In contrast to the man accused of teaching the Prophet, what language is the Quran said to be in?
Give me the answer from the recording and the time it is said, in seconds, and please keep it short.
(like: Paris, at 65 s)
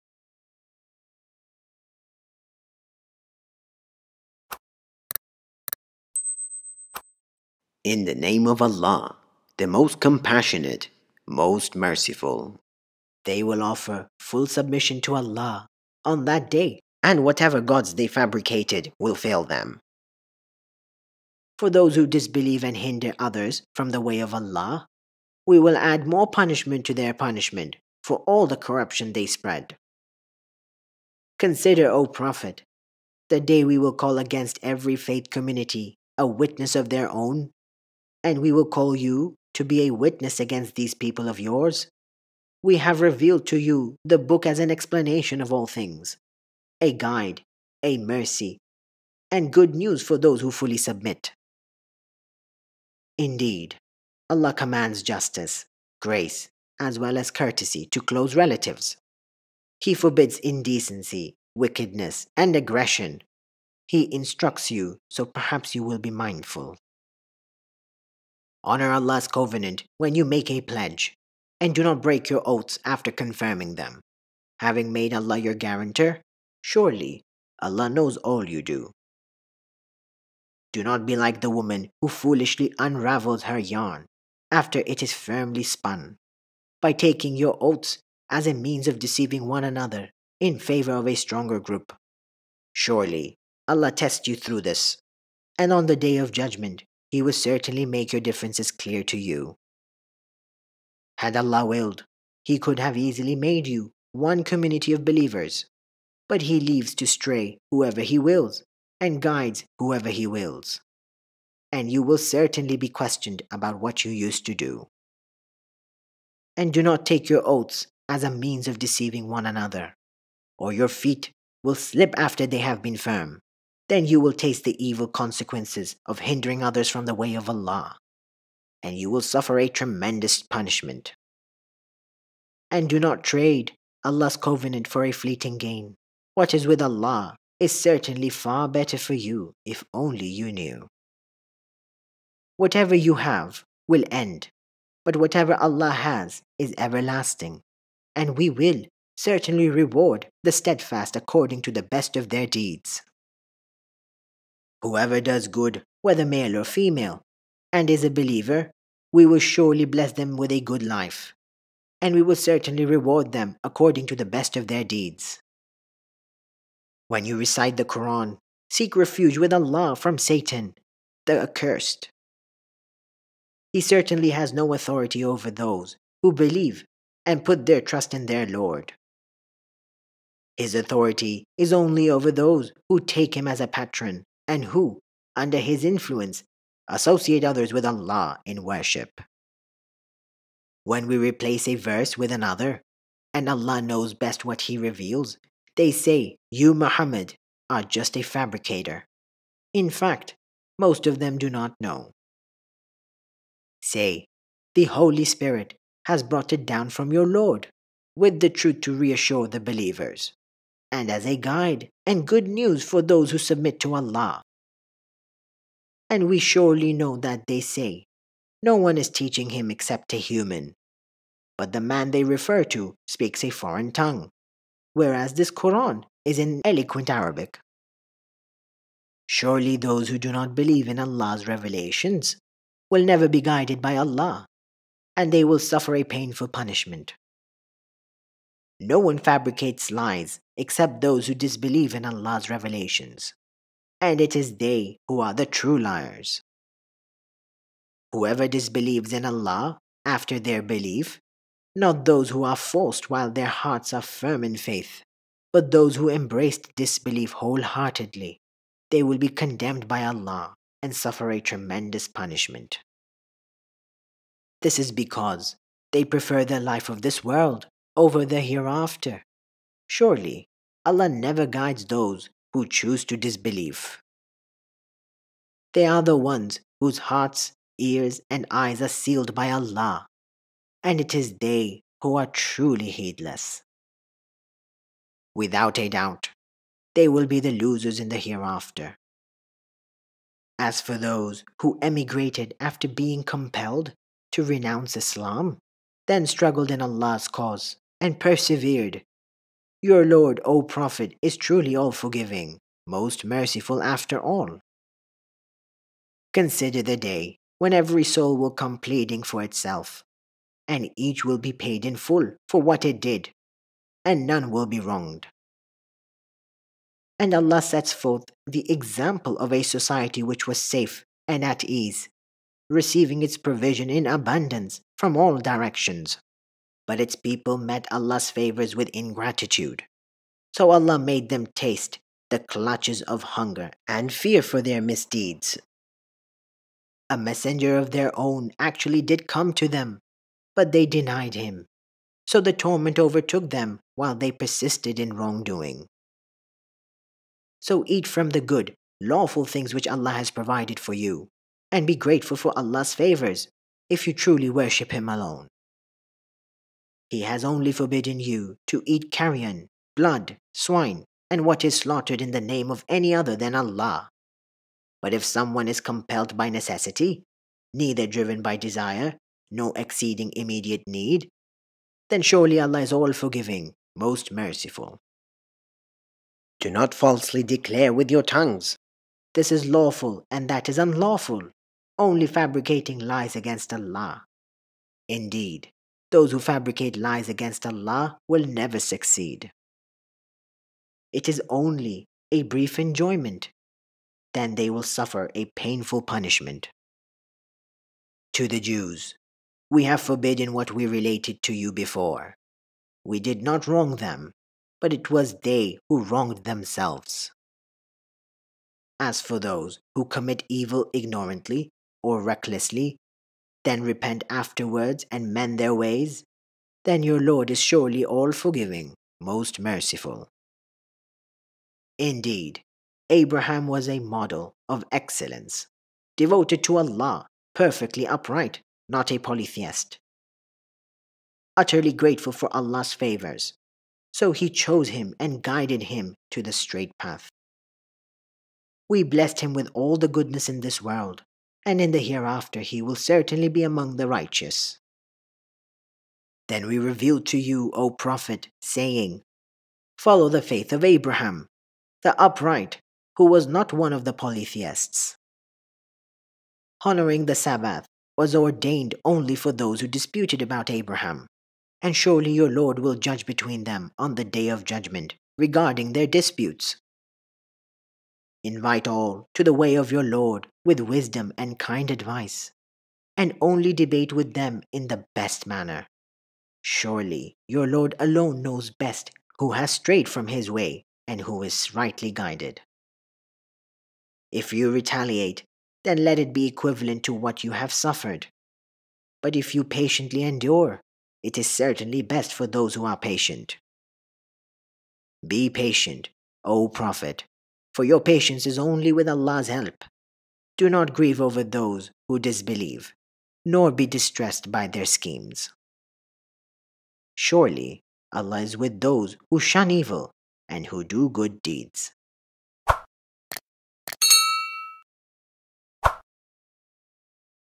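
Eloquent Arabic, at 226 s.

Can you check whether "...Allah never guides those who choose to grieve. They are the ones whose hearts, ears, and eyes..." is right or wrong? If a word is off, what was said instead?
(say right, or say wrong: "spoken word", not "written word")
wrong: "disbelieve", not "grieve".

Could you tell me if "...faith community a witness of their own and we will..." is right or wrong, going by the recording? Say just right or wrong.
right.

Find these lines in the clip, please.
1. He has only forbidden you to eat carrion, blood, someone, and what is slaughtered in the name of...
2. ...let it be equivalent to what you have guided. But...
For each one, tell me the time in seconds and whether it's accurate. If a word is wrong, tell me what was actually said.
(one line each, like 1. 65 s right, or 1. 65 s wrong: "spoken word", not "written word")
1. 357 s wrong: "swine", not "someone"
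2. 486 s wrong: "suffered", not "guided".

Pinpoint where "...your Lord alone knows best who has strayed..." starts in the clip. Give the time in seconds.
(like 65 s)
477 s.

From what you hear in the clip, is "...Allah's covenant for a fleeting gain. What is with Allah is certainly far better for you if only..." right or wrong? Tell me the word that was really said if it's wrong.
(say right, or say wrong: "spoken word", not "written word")
right.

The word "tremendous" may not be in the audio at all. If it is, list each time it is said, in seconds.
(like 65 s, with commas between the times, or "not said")
129 s, 261 s.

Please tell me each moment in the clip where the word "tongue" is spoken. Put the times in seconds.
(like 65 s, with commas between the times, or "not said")
223 s, 378 s.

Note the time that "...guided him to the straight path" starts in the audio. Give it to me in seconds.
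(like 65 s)
435 s.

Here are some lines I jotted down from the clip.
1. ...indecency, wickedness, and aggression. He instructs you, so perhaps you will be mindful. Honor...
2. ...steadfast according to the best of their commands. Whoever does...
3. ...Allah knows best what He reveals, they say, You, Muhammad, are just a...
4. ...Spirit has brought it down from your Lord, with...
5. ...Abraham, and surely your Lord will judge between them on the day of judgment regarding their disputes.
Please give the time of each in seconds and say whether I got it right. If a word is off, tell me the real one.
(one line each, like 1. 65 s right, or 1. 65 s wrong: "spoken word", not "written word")
1. 60 s right
2. 150 s wrong: "deeds", not "commands"
3. 193 s right
4. 205 s right
5. 460 s right.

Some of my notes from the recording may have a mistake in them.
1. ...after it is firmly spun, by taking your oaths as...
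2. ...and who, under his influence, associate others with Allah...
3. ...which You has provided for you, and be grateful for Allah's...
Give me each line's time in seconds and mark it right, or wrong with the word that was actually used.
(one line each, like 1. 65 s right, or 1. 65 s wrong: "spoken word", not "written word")
1. 84 s right
2. 184 s right
3. 349 s wrong: "Allah", not "You".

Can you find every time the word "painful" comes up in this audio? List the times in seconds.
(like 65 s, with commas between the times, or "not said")
236 s, 395 s.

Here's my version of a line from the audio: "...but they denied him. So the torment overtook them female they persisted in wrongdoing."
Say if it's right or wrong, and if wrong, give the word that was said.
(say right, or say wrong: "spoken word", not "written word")
wrong: "while", not "female".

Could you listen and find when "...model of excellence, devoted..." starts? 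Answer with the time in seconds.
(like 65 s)
423 s.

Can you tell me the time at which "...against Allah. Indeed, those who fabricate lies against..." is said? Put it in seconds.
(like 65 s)
383 s.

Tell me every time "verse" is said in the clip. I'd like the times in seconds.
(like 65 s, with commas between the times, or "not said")
191 s.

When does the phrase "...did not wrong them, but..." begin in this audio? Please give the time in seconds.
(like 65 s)
403 s.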